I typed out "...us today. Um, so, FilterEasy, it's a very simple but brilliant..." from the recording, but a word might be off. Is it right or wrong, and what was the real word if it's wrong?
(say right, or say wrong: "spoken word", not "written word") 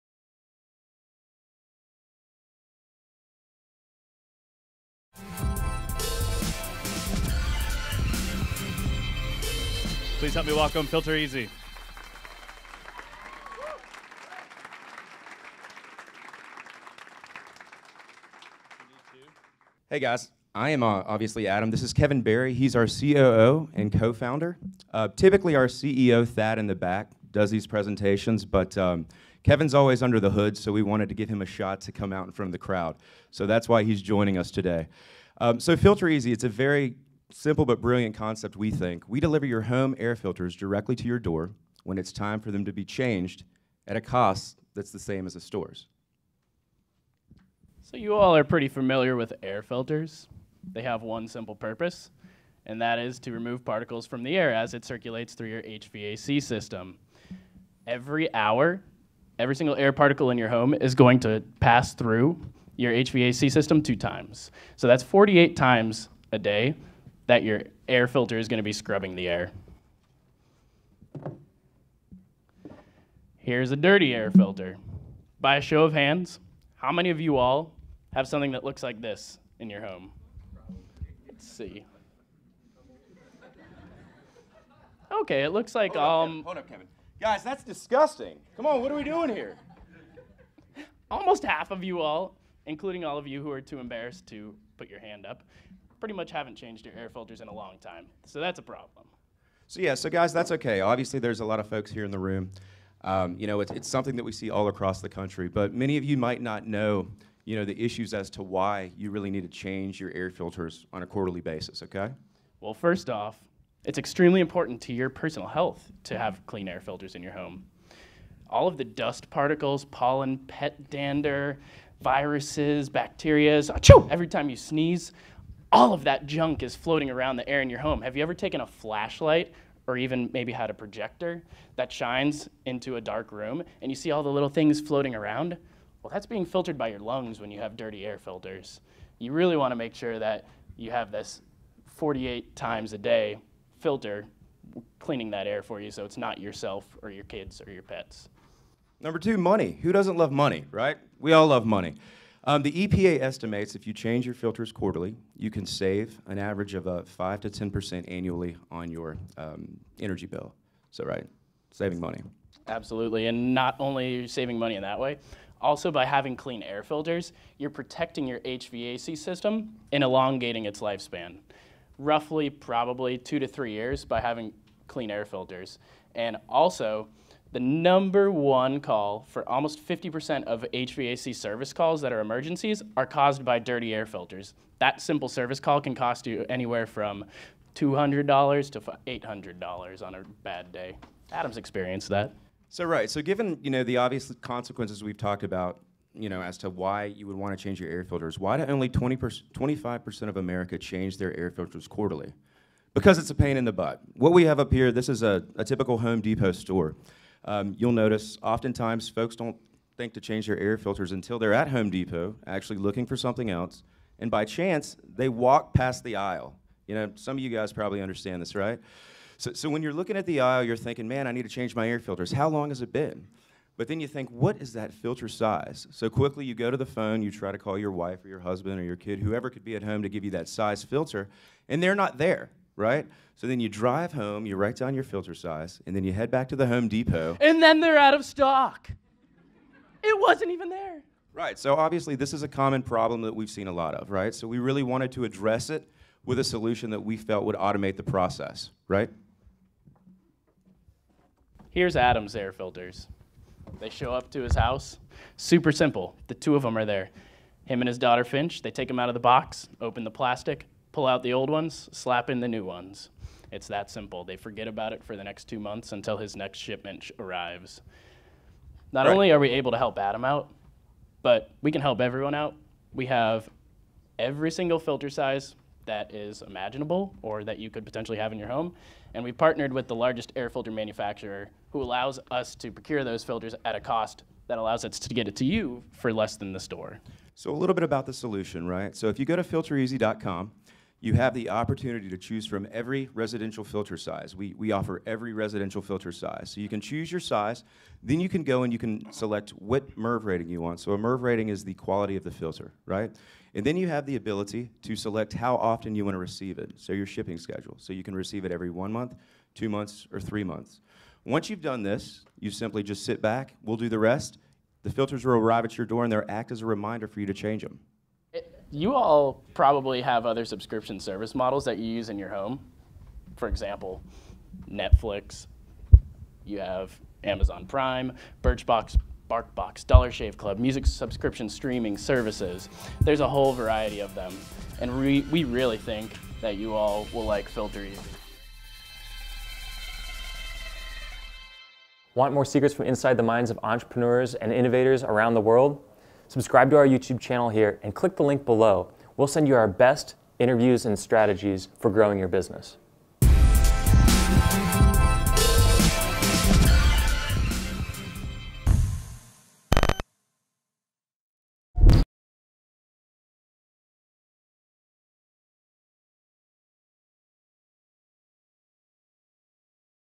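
right.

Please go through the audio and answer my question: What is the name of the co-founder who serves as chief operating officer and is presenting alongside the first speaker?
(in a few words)
Kevin Barry.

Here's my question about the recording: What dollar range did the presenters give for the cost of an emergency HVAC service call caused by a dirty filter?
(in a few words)
$200 to $800.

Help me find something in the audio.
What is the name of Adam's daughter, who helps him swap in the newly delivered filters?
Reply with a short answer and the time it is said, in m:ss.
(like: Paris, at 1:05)
Finch, at 4:18.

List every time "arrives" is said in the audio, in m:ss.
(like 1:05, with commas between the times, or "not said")
4:27, 5:15.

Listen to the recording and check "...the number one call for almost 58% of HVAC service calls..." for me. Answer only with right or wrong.
wrong.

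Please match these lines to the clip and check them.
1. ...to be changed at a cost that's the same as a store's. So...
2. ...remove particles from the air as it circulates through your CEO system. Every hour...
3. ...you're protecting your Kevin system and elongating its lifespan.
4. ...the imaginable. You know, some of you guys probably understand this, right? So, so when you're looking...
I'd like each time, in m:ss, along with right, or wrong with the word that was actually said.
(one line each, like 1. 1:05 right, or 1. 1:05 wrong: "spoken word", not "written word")
1. 0:42 right
2. 0:53 wrong: "HVAC", not "CEO"
3. 2:47 wrong: "HVAC", not "Kevin"
4. 3:36 wrong: "aisle", not "imaginable".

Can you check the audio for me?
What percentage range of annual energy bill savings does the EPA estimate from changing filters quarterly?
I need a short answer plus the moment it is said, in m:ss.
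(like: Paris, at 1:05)
5 to 10%, at 2:37.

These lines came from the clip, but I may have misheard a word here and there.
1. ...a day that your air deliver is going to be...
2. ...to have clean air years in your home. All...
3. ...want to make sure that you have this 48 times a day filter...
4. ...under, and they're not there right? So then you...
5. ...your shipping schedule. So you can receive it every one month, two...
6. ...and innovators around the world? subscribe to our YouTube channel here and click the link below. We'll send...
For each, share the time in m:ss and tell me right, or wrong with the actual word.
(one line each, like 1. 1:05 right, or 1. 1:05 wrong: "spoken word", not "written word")
1. 1:06 wrong: "filter", not "deliver"
2. 1:56 wrong: "filters", not "years"
3. 2:19 right
4. 3:50 wrong: "filter", not "under"
5. 5:06 right
6. 5:44 right.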